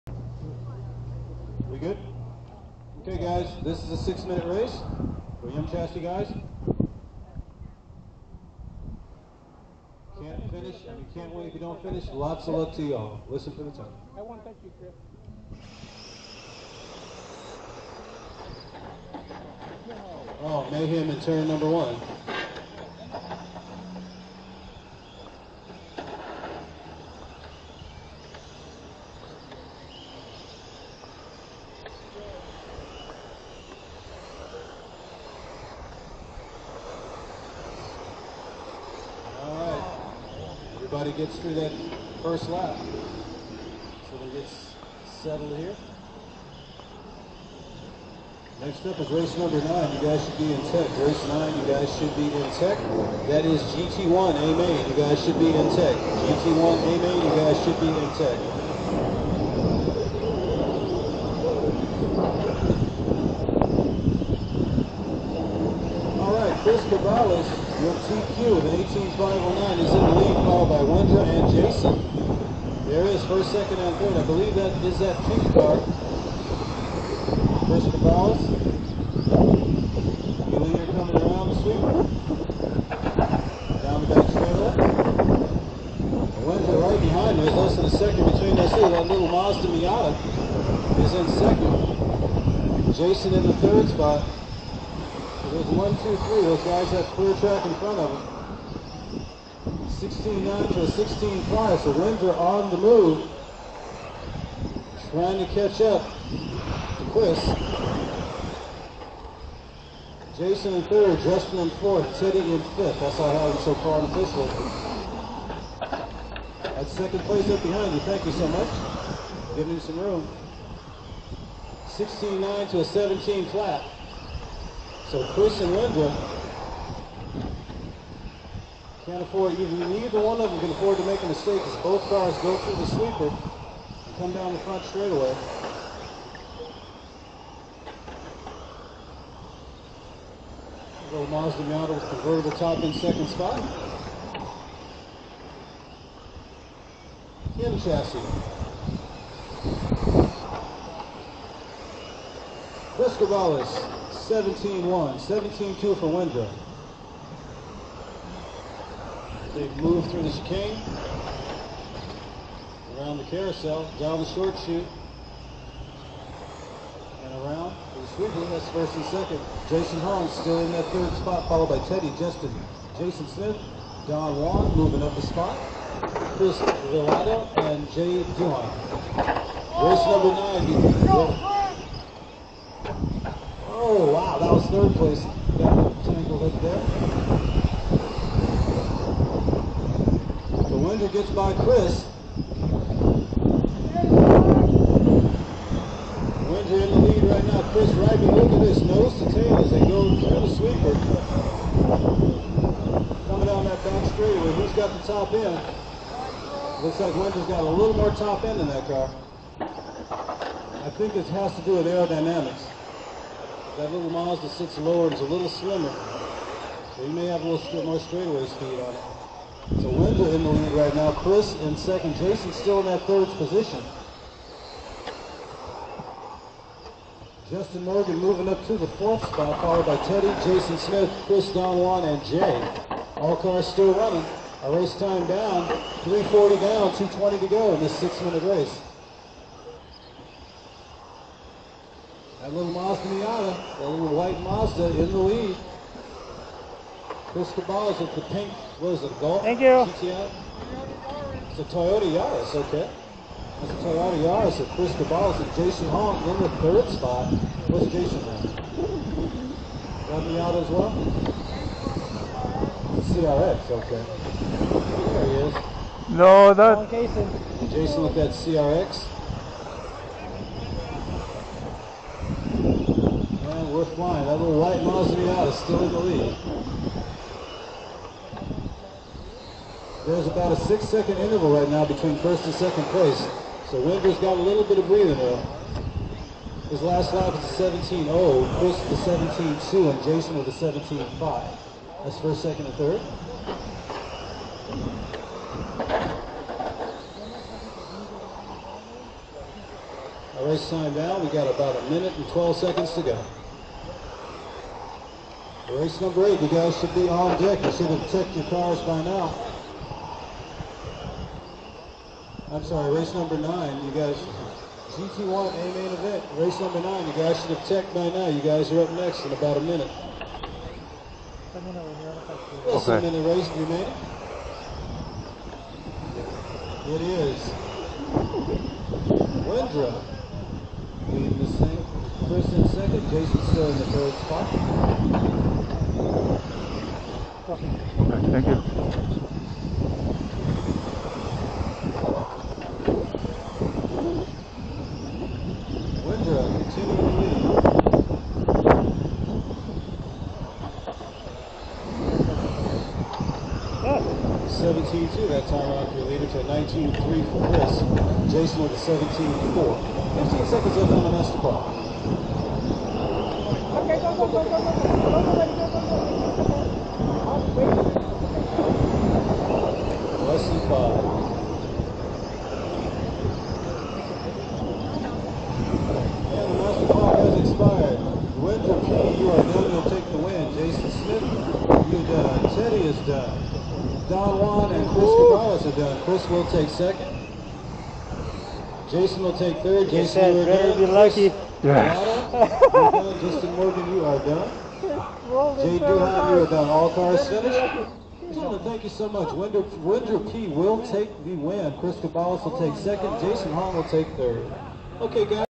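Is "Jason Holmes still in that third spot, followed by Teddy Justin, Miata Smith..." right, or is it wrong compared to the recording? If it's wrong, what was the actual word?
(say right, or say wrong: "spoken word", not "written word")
wrong: "Jason", not "Miata".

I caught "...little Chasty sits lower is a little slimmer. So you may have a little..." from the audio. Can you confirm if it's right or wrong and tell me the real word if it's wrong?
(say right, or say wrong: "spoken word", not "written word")
wrong: "Mazda", not "Chasty".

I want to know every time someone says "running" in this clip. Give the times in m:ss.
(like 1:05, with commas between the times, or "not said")
3:53.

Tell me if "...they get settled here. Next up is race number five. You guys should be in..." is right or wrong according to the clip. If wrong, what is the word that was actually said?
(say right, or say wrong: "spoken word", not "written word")
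wrong: "nine", not "five".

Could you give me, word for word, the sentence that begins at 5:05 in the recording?
Race number eight, you guys should be on deck.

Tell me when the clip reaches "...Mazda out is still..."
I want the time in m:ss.
4:34.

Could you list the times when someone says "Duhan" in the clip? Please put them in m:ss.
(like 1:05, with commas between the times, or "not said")
2:58, 6:35.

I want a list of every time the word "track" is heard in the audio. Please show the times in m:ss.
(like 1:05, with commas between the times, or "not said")
1:37.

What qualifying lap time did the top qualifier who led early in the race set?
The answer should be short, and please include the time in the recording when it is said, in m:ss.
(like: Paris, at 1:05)
18.509, at 1:08.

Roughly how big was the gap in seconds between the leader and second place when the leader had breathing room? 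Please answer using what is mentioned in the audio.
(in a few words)
6 seconds.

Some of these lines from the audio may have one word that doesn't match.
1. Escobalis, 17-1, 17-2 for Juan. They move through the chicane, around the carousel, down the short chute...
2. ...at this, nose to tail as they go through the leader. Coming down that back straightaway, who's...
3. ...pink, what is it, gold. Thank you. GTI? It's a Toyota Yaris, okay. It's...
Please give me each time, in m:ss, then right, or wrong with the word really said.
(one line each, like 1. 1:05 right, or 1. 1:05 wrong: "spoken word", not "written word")
1. 2:32 wrong: "Wendra", not "Juan"
2. 3:18 wrong: "sweeper", not "leader"
3. 4:08 right.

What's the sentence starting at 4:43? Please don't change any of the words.
So Winder's got a little bit of breathing room.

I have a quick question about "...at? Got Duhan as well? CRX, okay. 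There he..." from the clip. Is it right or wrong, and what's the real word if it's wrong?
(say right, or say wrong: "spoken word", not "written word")
wrong: "Miata", not "Duhan".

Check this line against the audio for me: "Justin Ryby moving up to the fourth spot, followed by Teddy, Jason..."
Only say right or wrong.
wrong.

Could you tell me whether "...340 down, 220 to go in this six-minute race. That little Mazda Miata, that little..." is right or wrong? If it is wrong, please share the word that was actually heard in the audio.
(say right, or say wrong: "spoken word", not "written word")
right.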